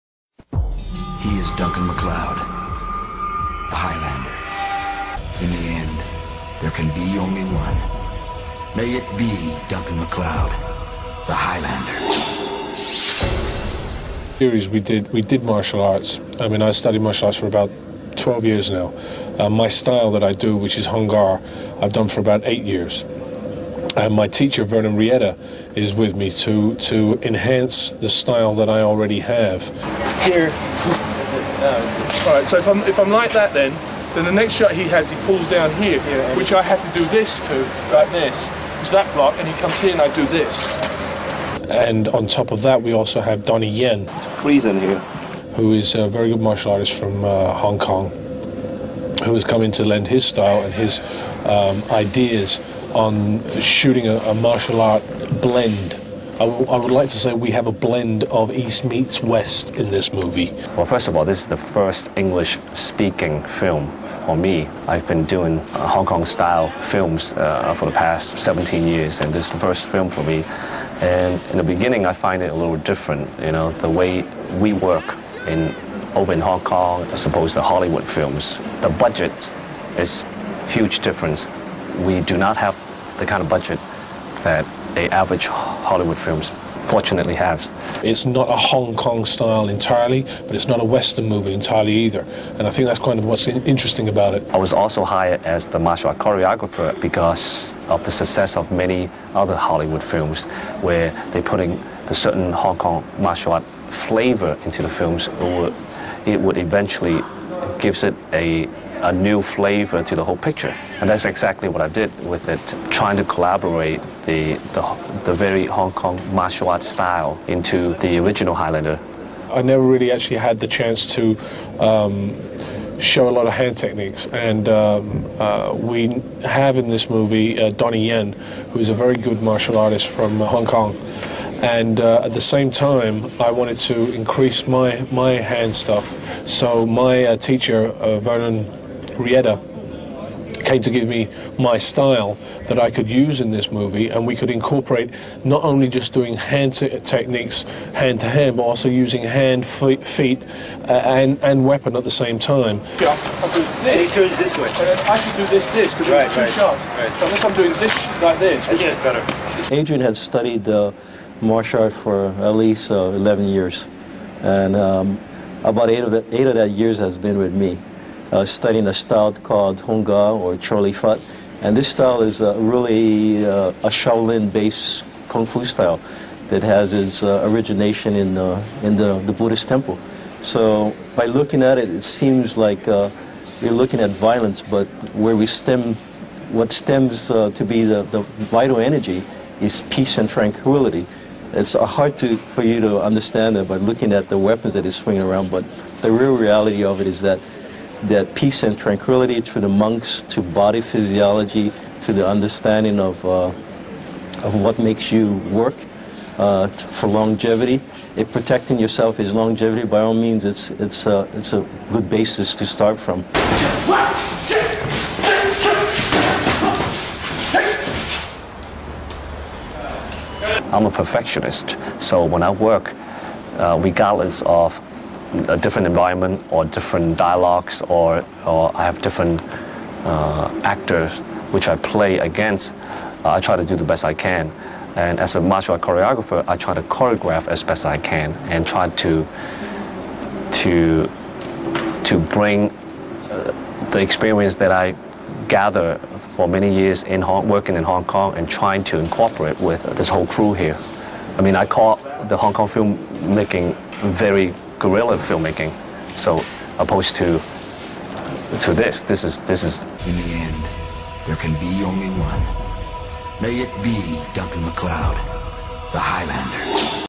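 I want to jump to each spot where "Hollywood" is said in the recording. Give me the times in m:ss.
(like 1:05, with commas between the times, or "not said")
1:17, 1:25, 1:39.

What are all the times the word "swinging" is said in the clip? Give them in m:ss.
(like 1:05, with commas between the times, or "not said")
3:14.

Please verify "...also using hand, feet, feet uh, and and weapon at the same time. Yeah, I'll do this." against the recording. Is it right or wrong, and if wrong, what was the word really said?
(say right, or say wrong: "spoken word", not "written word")
right.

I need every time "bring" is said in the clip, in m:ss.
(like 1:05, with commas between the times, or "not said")
4:02.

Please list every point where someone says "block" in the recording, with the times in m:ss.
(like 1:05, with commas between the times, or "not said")
0:39.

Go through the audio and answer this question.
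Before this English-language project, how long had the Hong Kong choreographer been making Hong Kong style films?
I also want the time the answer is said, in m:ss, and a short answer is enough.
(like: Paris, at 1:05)
17 years, at 1:07.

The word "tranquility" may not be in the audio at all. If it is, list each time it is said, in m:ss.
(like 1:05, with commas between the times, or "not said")
3:10, 3:18.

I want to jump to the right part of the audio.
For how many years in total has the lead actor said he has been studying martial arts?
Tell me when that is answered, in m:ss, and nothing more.
0:17.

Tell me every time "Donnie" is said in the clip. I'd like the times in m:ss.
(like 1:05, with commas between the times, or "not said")
0:43, 2:07.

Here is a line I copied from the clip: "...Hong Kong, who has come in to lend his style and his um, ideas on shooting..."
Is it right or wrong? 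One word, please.
right.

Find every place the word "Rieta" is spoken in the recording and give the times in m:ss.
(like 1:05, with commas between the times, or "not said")
0:24, 2:19.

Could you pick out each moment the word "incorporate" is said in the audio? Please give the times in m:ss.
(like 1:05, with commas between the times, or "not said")
2:24, 4:08.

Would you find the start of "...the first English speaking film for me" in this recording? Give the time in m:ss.
1:01.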